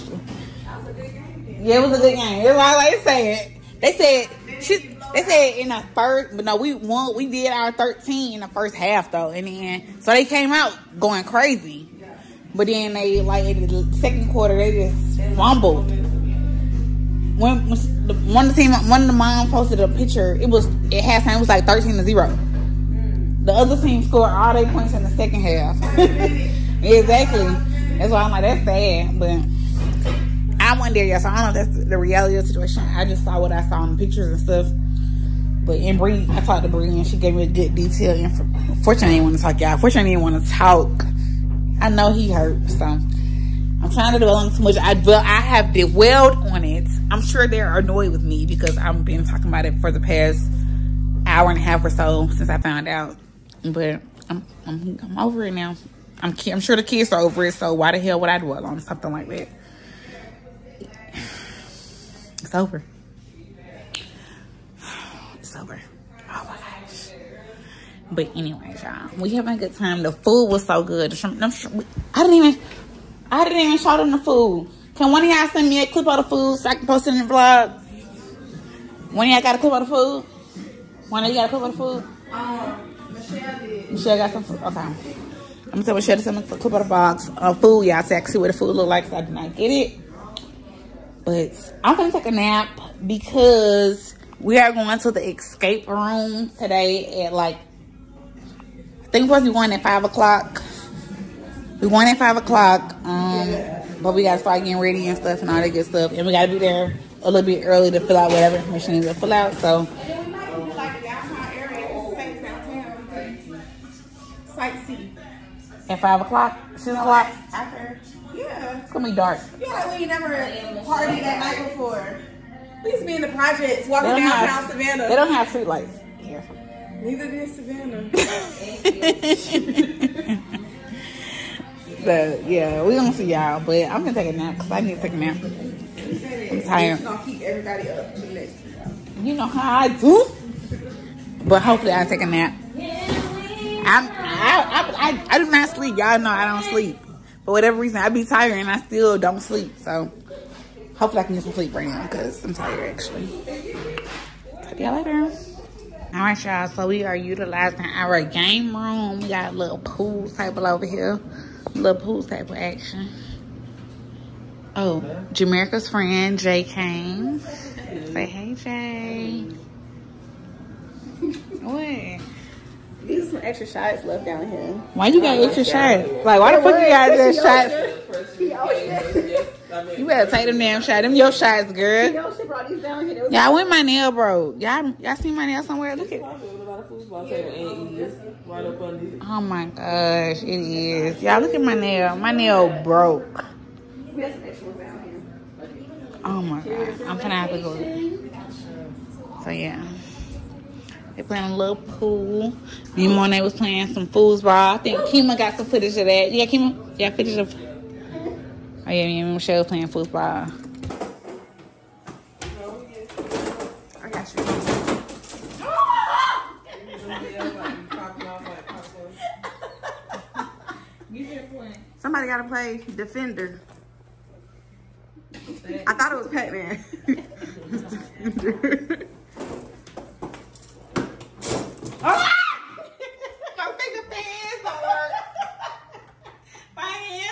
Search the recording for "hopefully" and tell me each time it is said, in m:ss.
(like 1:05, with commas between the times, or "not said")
2:21, 2:30.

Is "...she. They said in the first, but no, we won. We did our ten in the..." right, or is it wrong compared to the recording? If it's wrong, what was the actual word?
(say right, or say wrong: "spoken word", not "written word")
wrong: "thirteen", not "ten".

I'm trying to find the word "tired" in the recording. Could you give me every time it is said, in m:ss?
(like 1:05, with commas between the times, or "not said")
2:16, 2:28, 2:32.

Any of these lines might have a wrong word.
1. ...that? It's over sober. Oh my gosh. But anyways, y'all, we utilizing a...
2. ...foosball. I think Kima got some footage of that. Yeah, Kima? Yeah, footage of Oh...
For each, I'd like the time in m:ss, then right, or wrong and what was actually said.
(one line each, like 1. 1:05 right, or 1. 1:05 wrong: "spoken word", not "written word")
1. 0:59 wrong: "having", not "utilizing"
2. 3:24 right.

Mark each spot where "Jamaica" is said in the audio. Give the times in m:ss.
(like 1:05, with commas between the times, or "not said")
2:45.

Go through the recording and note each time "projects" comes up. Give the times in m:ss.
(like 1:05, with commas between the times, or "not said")
2:03.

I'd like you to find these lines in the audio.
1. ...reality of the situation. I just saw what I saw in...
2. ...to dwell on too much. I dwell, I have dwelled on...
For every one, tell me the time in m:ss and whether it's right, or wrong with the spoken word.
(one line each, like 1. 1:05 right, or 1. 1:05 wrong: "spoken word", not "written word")
1. 0:31 right
2. 0:44 right.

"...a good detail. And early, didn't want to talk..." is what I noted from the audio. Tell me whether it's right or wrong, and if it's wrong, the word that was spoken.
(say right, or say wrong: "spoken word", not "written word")
wrong: "fortunately", not "early".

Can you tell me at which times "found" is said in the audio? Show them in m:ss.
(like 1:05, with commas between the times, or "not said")
0:52.